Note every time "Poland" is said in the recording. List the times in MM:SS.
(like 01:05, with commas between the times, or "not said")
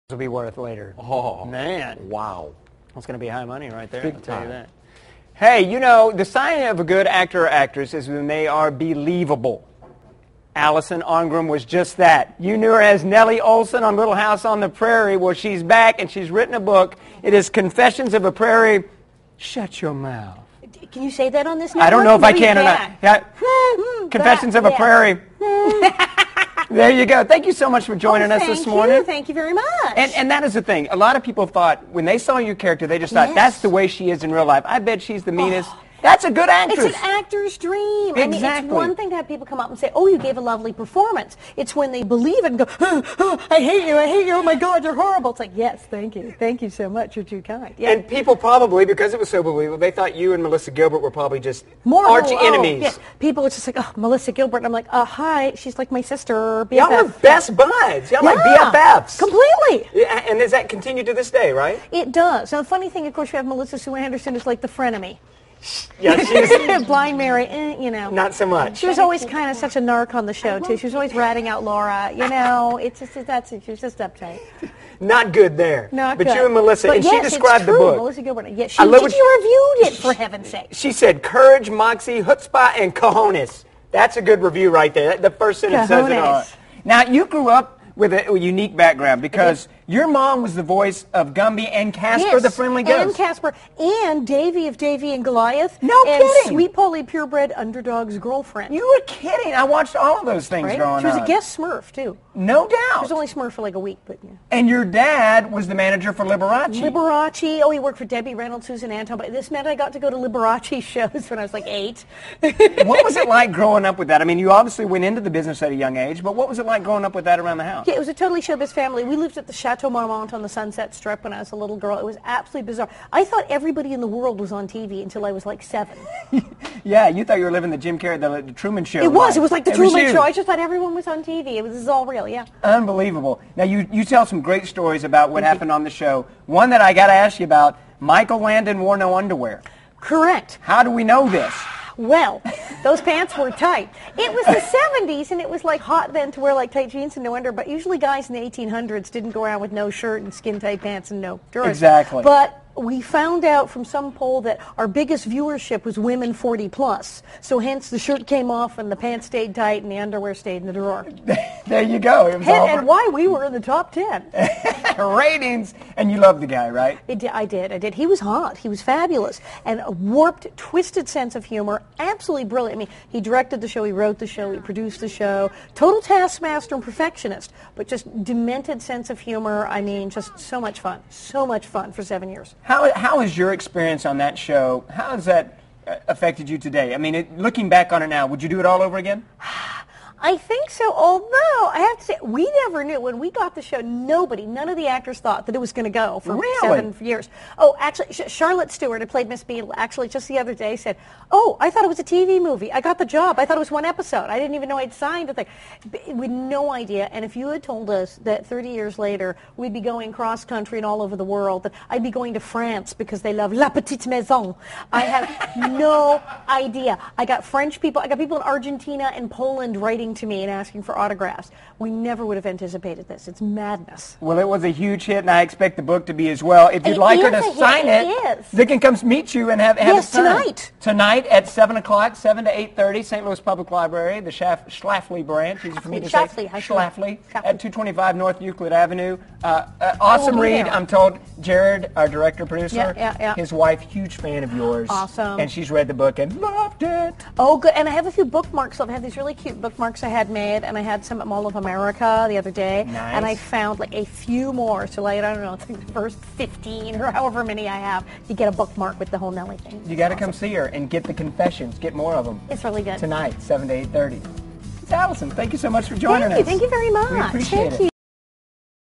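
03:39.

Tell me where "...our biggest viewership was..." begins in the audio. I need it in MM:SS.
02:34.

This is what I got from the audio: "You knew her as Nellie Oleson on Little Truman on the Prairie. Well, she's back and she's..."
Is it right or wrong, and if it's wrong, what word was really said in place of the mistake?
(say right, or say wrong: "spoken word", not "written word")
wrong: "House", not "Truman".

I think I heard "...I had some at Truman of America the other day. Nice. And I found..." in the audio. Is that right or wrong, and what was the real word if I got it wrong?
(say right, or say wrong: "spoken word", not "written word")
wrong: "Mall", not "Truman".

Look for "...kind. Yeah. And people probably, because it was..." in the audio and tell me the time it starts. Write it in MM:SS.
00:47.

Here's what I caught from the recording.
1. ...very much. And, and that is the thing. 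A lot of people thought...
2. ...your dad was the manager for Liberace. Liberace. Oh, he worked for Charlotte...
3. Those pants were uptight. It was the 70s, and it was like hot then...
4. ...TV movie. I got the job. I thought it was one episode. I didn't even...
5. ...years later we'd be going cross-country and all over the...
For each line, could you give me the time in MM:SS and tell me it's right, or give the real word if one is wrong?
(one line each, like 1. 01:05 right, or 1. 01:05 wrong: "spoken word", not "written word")
1. 00:29 right
2. 01:44 wrong: "Debbie", not "Charlotte"
3. 02:22 wrong: "tight", not "uptight"
4. 03:22 right
5. 03:28 right.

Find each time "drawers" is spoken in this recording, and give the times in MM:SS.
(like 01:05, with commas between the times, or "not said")
02:31, 02:40.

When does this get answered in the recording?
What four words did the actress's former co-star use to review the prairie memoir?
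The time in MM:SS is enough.
01:21.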